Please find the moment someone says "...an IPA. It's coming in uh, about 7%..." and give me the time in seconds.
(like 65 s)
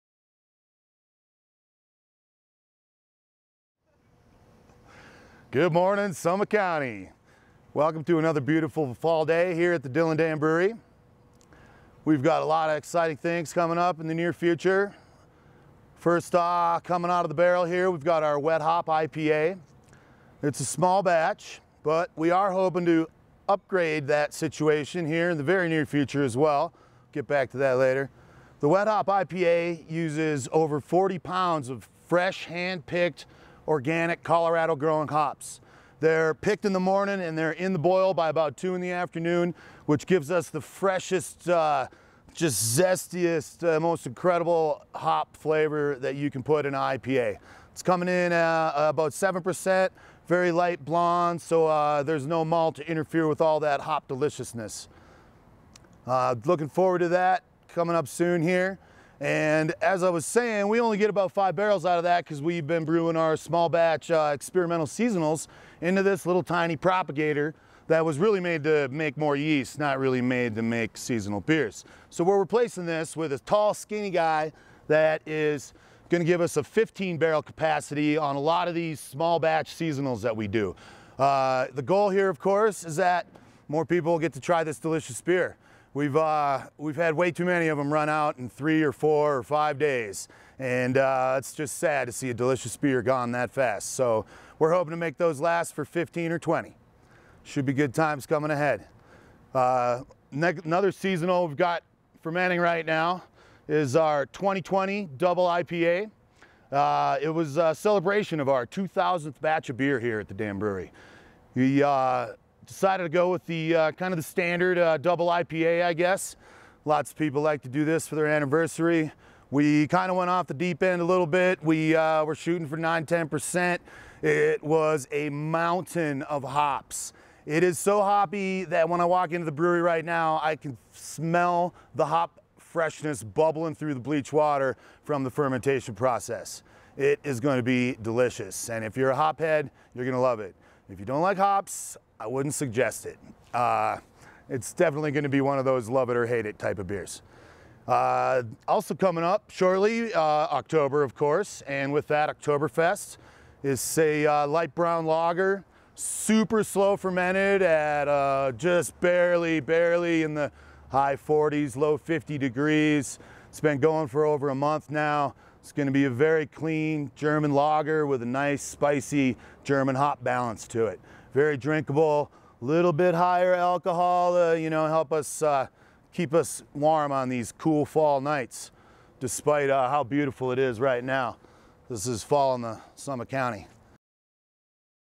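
46 s.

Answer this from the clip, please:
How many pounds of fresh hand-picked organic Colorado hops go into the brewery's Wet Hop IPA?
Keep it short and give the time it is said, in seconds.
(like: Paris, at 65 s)
over 40 pounds, at 30 s.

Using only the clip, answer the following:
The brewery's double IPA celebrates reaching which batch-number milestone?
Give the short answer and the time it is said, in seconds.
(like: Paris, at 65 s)
2,000th batch, at 108 s.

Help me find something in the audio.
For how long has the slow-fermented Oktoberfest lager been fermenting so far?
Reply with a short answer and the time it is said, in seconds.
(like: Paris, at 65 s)
over a month, at 164 s.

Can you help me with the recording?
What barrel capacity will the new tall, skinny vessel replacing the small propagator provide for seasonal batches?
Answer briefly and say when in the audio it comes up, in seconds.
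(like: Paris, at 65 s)
15 barrel, at 76 s.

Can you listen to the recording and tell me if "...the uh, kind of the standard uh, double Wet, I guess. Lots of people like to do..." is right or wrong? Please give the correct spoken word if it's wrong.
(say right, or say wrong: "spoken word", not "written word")
wrong: "IPA", not "Wet".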